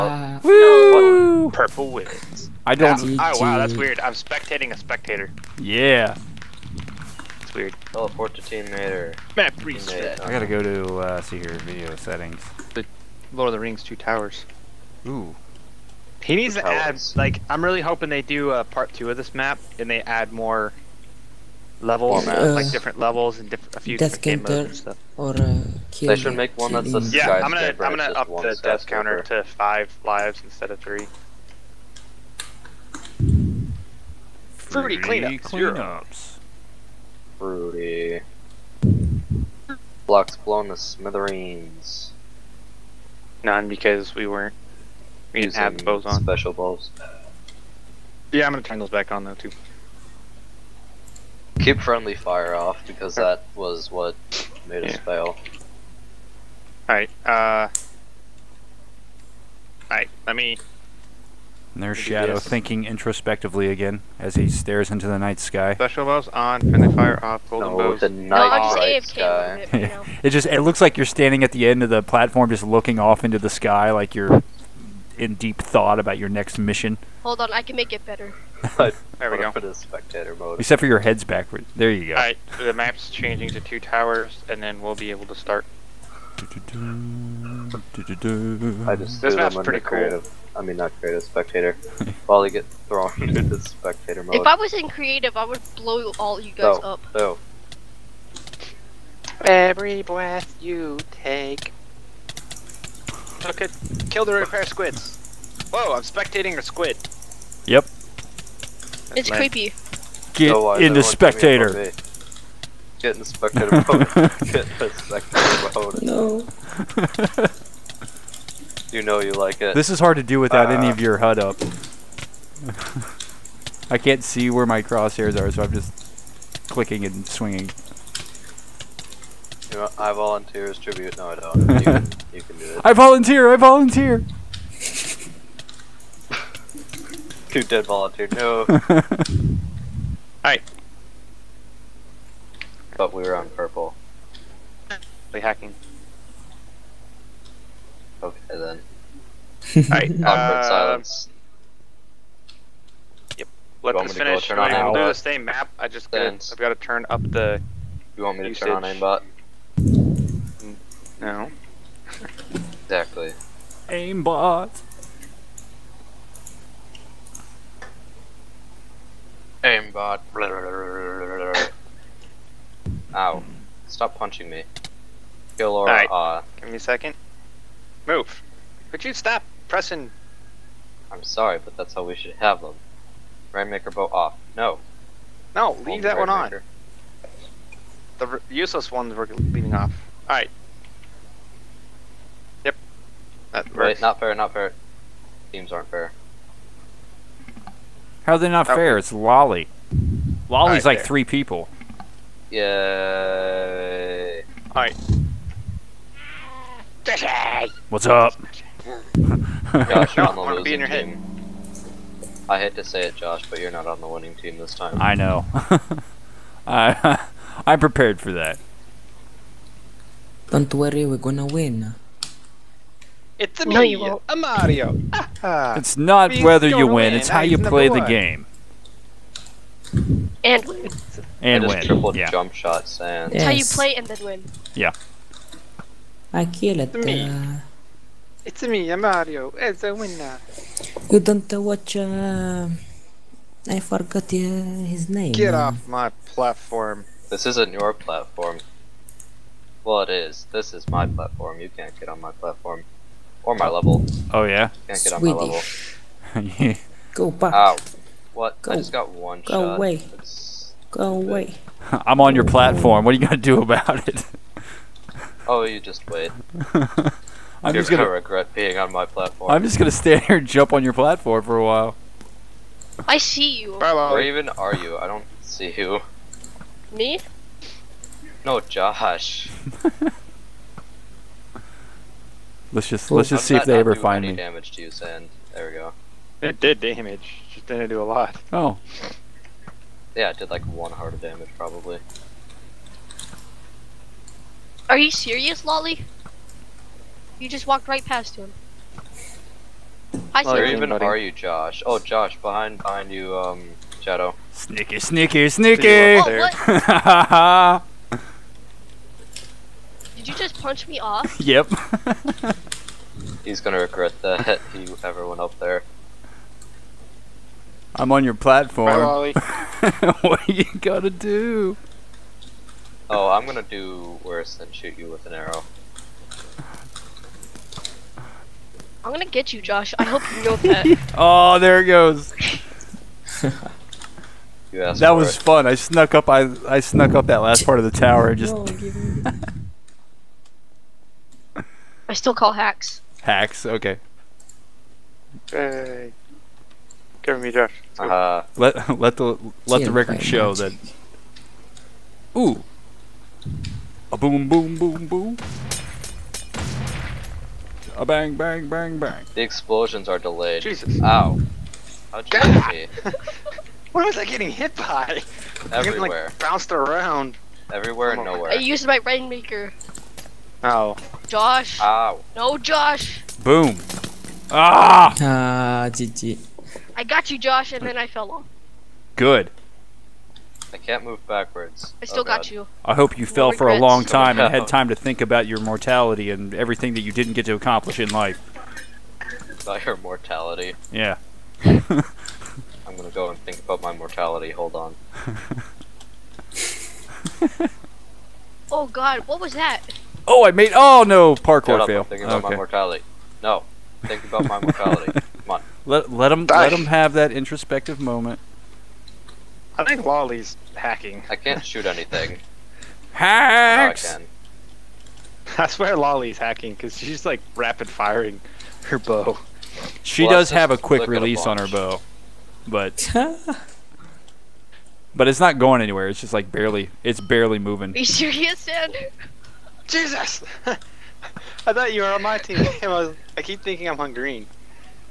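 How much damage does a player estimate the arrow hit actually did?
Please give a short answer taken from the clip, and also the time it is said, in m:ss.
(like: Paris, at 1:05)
One heart, at 4:50.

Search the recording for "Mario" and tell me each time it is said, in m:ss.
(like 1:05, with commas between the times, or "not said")
3:44, 3:59.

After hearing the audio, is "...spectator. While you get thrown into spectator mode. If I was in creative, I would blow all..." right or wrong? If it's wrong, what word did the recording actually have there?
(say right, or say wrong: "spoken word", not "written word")
right.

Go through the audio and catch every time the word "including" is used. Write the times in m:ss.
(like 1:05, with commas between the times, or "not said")
not said.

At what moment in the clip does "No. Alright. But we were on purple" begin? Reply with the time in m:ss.
2:18.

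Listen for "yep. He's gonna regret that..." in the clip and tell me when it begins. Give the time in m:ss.
5:11.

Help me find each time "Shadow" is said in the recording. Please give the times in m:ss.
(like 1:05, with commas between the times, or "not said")
1:01, 5:04.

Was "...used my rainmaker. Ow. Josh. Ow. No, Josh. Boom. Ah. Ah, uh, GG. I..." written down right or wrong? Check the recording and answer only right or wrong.
right.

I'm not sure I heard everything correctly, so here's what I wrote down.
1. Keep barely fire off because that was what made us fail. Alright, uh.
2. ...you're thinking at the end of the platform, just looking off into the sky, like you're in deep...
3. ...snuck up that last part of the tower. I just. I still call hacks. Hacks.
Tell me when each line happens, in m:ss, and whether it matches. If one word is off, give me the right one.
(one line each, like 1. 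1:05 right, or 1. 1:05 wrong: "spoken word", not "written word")
1. 0:51 wrong: "friendly", not "barely"
2. 1:10 wrong: "standing", not "thinking"
3. 5:36 right.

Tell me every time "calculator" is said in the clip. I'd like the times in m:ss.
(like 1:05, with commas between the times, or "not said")
not said.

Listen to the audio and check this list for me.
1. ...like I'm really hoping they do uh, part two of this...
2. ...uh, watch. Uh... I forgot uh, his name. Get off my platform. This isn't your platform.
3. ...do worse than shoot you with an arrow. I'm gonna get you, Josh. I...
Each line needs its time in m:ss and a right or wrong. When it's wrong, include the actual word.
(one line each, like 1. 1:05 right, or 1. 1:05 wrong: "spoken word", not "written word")
1. 0:17 right
2. 4:01 right
3. 5:23 right.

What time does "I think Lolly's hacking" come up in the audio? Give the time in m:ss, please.
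6:49.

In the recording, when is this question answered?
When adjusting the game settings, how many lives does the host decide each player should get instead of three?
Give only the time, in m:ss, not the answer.
0:29.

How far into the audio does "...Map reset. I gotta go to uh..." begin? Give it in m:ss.
0:08.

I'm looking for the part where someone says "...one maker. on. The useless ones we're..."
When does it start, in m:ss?
3:06.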